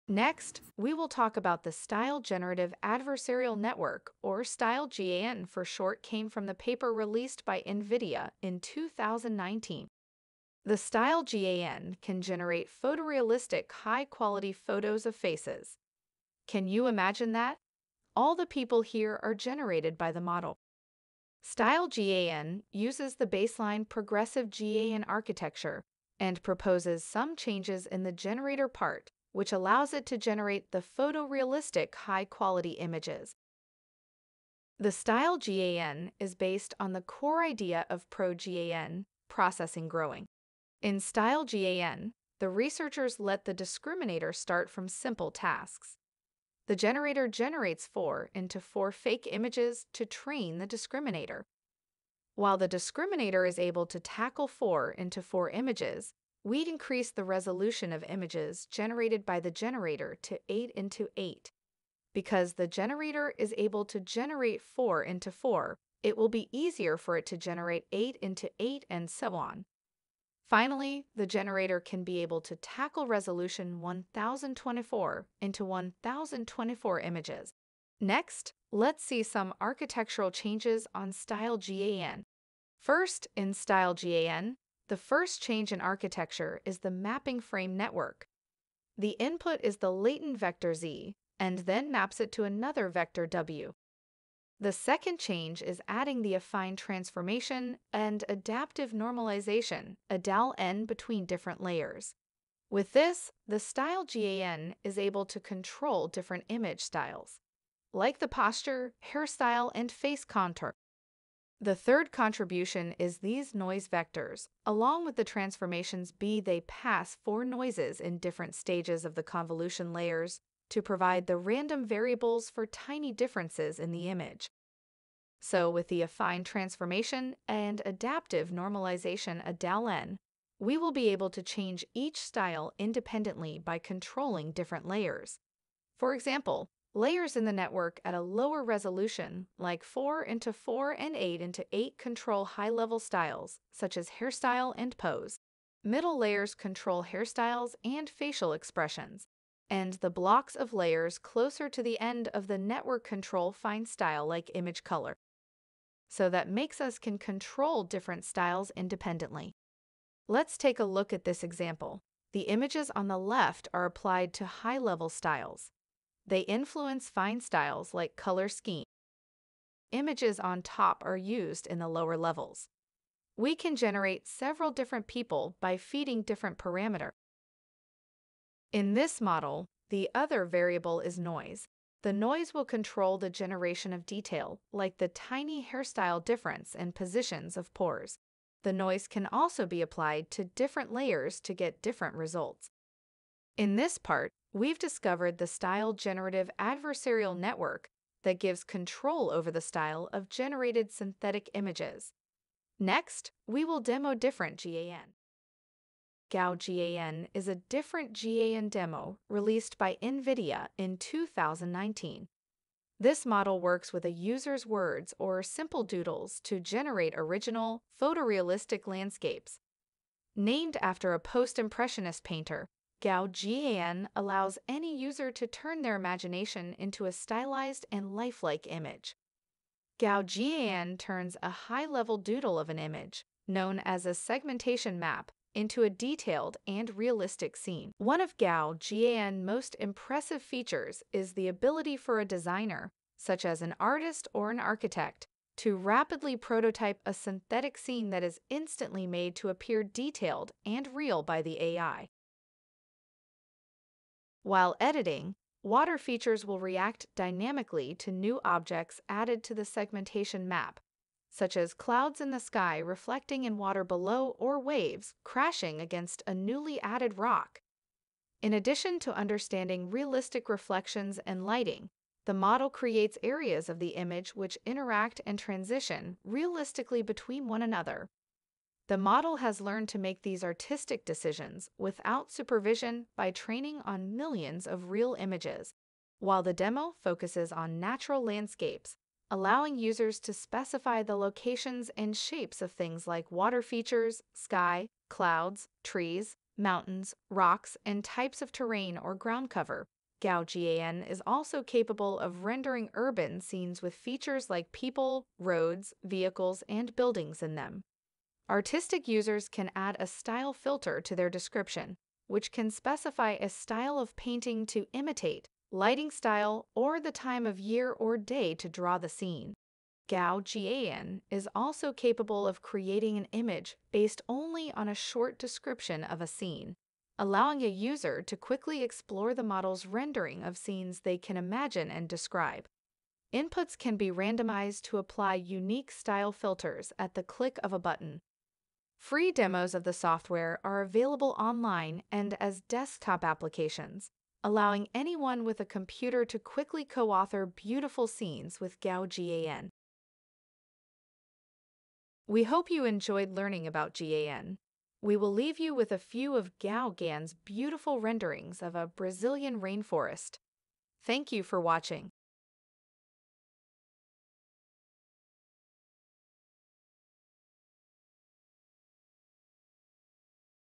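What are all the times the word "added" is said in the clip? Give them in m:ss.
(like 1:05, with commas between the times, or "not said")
4:19, 4:26.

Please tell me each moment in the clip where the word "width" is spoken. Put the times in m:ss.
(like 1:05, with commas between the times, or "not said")
not said.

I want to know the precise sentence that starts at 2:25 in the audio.
Middle layers control hairstyles and facial expressions.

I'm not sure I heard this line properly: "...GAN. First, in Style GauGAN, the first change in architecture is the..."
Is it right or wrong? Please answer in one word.
wrong.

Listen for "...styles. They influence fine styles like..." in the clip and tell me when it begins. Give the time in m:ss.
2:45.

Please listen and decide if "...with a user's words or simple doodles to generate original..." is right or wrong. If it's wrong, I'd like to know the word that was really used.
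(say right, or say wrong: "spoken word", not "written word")
right.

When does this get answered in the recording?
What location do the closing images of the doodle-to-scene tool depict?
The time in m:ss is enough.
5:58.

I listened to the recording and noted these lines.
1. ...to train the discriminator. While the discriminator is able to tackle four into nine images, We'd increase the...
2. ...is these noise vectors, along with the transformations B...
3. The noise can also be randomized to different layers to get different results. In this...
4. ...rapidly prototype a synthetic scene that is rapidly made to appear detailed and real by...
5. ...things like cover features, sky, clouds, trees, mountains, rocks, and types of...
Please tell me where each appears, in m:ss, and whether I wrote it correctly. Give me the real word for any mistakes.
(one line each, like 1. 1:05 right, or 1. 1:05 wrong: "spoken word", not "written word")
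1. 0:49 wrong: "four", not "nine"
2. 1:52 right
3. 3:08 wrong: "applied", not "randomized"
4. 4:05 wrong: "instantly", not "rapidly"
5. 4:52 wrong: "water", not "cover".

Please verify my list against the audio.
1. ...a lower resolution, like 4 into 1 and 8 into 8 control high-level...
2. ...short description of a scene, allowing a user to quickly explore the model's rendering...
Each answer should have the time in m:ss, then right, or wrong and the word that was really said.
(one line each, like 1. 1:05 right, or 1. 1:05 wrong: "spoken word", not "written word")
1. 2:18 wrong: "4", not "1"
2. 5:24 right.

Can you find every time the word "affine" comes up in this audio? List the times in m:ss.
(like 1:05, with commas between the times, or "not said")
1:36, 2:06.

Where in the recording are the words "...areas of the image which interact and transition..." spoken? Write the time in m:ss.
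4:33.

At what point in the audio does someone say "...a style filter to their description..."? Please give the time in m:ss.
5:09.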